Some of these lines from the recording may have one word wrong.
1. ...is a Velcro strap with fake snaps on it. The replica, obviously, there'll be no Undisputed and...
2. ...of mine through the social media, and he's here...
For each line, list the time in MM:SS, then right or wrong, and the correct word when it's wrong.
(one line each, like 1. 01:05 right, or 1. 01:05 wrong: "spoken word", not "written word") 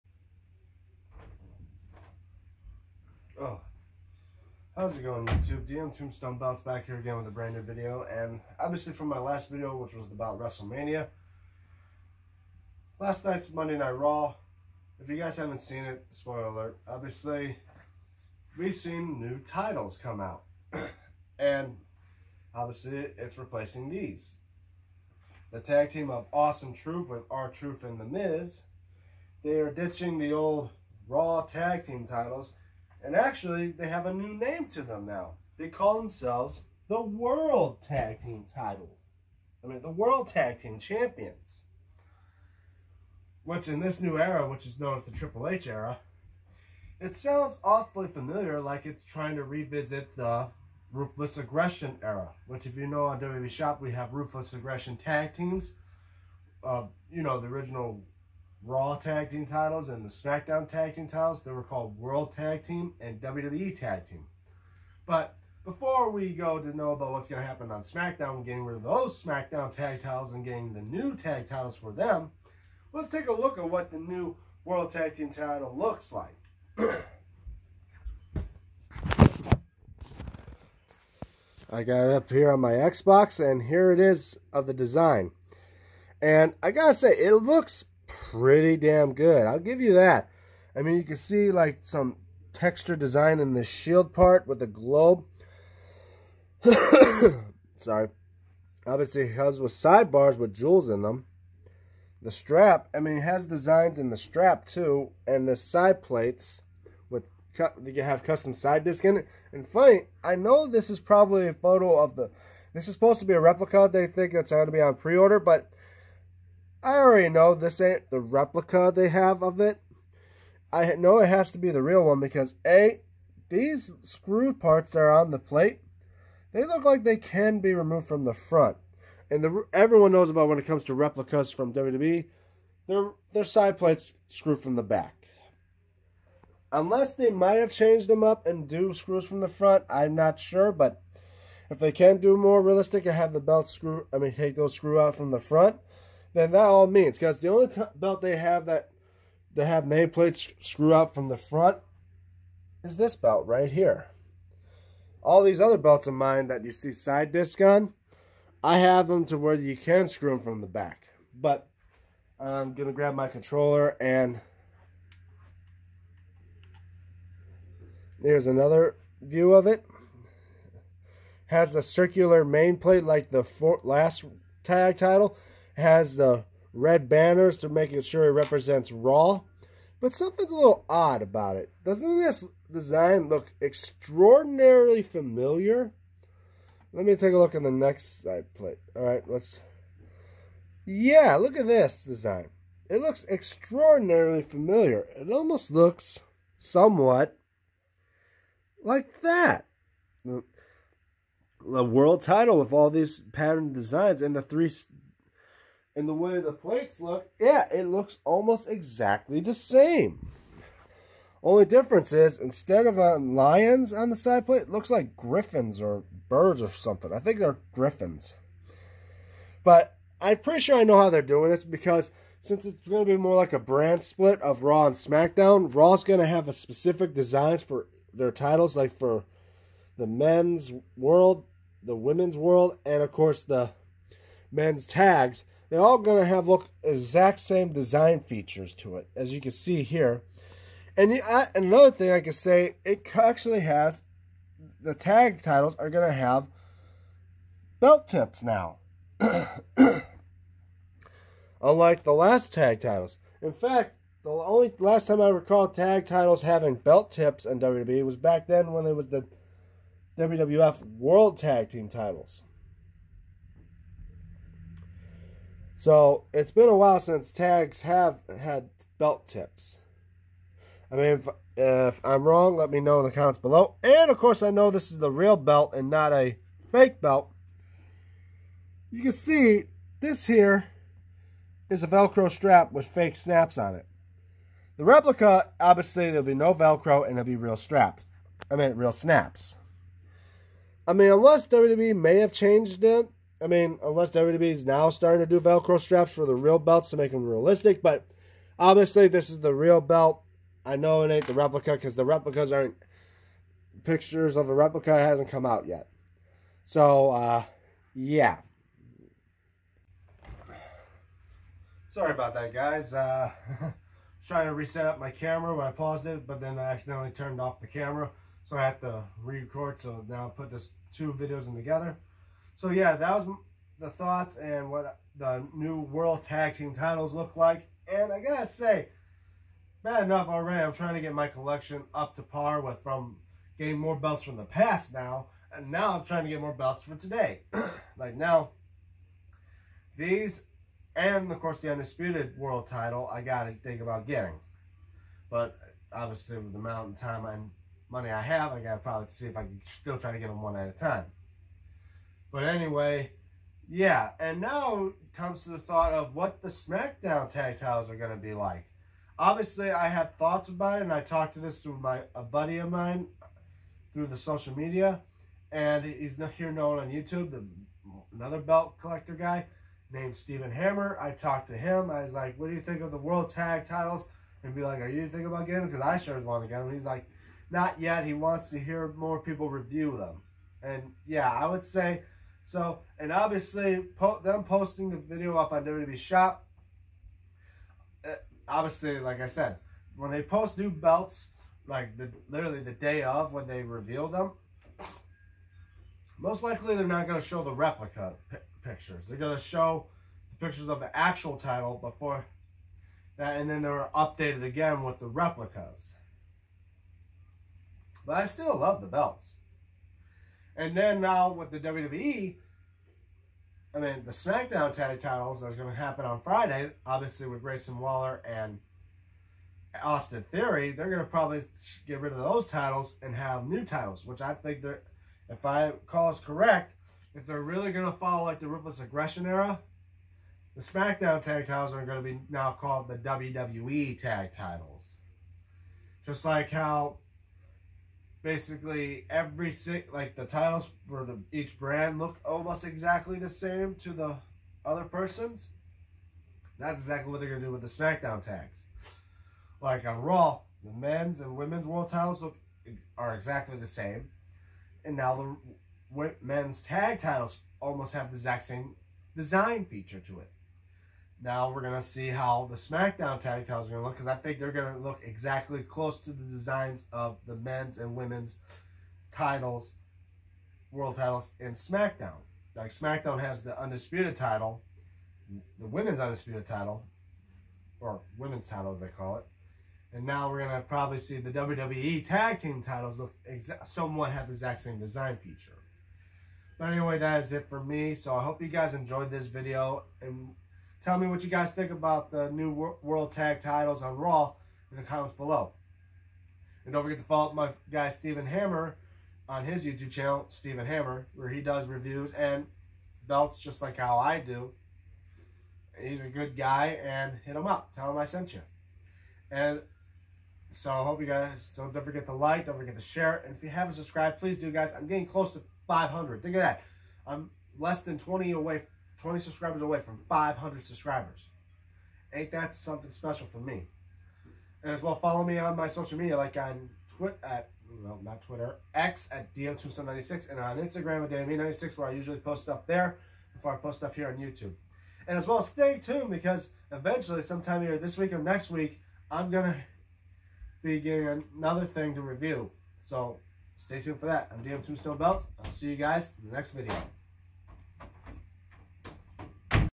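1. 04:41 wrong: "Velcro", not "Undisputed"
2. 06:02 right.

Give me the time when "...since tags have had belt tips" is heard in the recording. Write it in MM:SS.
04:26.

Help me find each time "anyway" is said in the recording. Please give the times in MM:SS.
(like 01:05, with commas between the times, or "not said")
05:52, 08:06.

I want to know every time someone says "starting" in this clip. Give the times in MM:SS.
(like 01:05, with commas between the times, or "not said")
04:54.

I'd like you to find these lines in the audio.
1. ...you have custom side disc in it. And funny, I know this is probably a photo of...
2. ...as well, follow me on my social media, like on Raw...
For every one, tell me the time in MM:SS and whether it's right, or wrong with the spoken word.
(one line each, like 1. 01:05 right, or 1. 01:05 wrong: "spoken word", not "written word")
1. 01:47 right
2. 08:44 wrong: "Twitter", not "Raw".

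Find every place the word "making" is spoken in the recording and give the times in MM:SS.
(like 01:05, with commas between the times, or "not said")
02:57.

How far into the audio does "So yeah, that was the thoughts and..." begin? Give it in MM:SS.
05:22.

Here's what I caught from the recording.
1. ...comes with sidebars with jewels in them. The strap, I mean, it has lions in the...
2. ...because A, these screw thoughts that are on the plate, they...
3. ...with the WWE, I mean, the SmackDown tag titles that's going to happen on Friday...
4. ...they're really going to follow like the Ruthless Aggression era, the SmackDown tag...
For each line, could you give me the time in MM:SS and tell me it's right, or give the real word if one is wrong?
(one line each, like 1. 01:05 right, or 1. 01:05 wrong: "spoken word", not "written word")
1. 01:39 wrong: "designs", not "lions"
2. 02:02 wrong: "parts", not "thoughts"
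3. 06:51 right
4. 07:07 right.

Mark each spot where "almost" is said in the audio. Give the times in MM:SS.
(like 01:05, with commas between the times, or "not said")
03:15, 03:28, 07:22, 07:37.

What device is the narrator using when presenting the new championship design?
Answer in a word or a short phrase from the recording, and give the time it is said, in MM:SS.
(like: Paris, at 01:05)
Xbox, at 01:22.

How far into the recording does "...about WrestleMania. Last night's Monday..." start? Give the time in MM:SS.
00:10.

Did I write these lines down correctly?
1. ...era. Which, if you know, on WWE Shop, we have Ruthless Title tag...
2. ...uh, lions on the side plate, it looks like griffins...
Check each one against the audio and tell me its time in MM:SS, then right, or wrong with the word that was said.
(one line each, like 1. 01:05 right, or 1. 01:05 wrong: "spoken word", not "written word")
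1. 00:52 wrong: "Aggression", not "Title"
2. 03:32 right.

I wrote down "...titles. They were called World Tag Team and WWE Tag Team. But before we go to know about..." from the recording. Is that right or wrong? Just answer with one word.
right.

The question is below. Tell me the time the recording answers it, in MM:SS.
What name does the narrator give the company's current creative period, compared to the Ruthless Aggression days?
00:45.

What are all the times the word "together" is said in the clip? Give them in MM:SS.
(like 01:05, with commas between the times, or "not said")
05:21.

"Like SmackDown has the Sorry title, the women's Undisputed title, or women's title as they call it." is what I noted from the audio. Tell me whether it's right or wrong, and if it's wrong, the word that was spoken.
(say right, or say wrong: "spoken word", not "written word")
wrong: "Undisputed", not "Sorry".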